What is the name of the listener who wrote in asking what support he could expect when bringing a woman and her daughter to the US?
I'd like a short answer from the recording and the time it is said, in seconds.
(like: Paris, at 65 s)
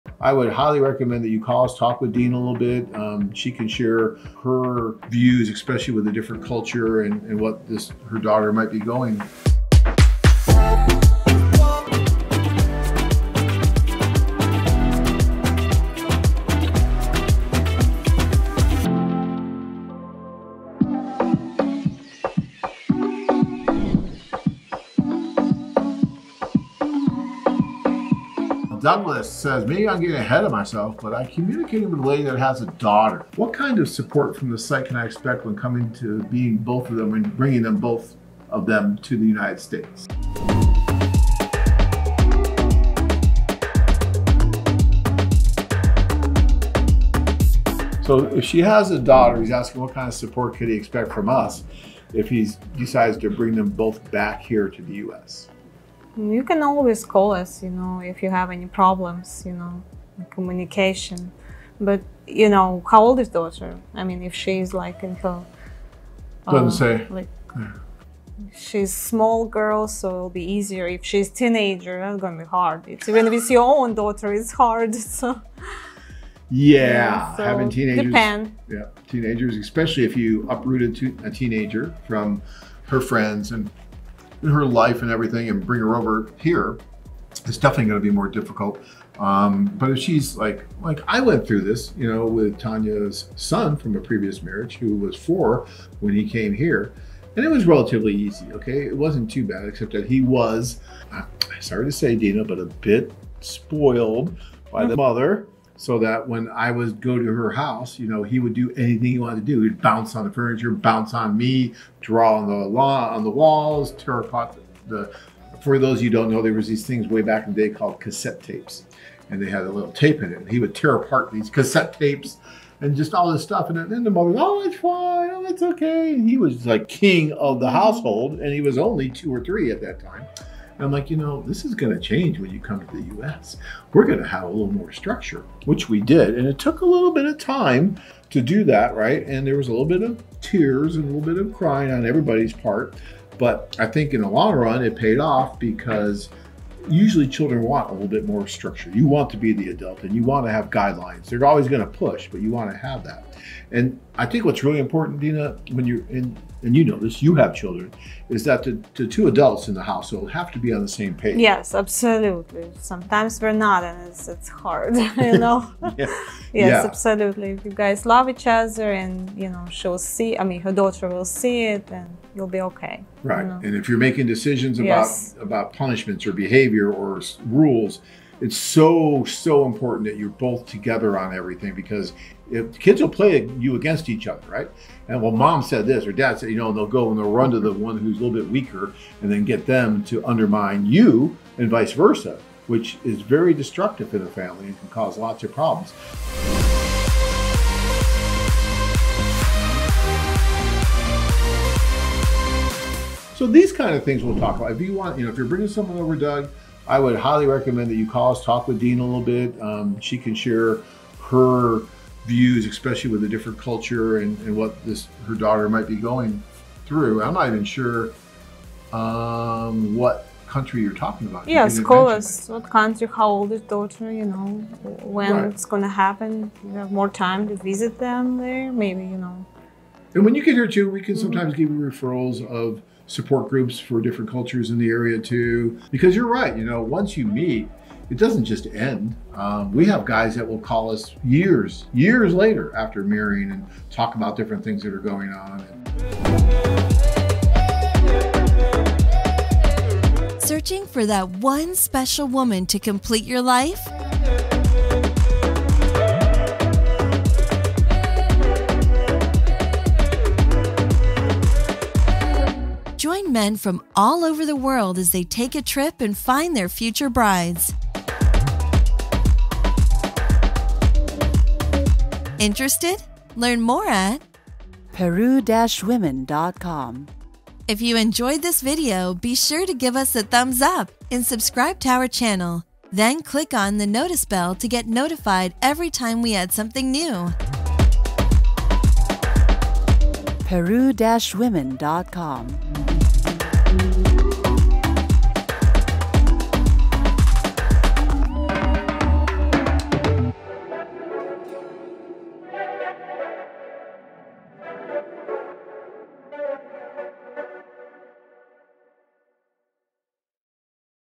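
Douglas, at 28 s.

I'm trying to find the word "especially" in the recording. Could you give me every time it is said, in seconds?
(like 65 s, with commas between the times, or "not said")
5 s, 79 s, 212 s.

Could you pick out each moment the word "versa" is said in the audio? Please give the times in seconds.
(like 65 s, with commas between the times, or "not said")
191 s.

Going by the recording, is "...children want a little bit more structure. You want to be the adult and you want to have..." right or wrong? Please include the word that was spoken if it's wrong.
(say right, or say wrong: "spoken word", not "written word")
right.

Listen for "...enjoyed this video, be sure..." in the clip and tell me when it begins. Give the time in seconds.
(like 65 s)
277 s.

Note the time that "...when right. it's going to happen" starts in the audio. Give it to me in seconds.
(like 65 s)
225 s.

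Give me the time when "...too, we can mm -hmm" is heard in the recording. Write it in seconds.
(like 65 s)
230 s.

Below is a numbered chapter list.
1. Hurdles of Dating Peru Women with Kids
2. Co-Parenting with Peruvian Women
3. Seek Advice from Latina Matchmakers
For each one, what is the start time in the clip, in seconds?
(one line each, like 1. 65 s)
1. 28 s
2. 155 s
3. 204 s.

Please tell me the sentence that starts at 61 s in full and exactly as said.
But, you know, how old is daughter?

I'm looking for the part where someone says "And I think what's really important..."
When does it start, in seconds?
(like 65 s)
153 s.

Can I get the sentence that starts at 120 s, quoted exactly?
And he would tear apart these cassette tapes and just all this stuff.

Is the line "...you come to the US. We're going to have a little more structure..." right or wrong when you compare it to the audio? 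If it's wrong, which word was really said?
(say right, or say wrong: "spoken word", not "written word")
right.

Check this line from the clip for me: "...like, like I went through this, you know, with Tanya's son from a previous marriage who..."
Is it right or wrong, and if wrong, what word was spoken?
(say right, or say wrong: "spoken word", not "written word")
right.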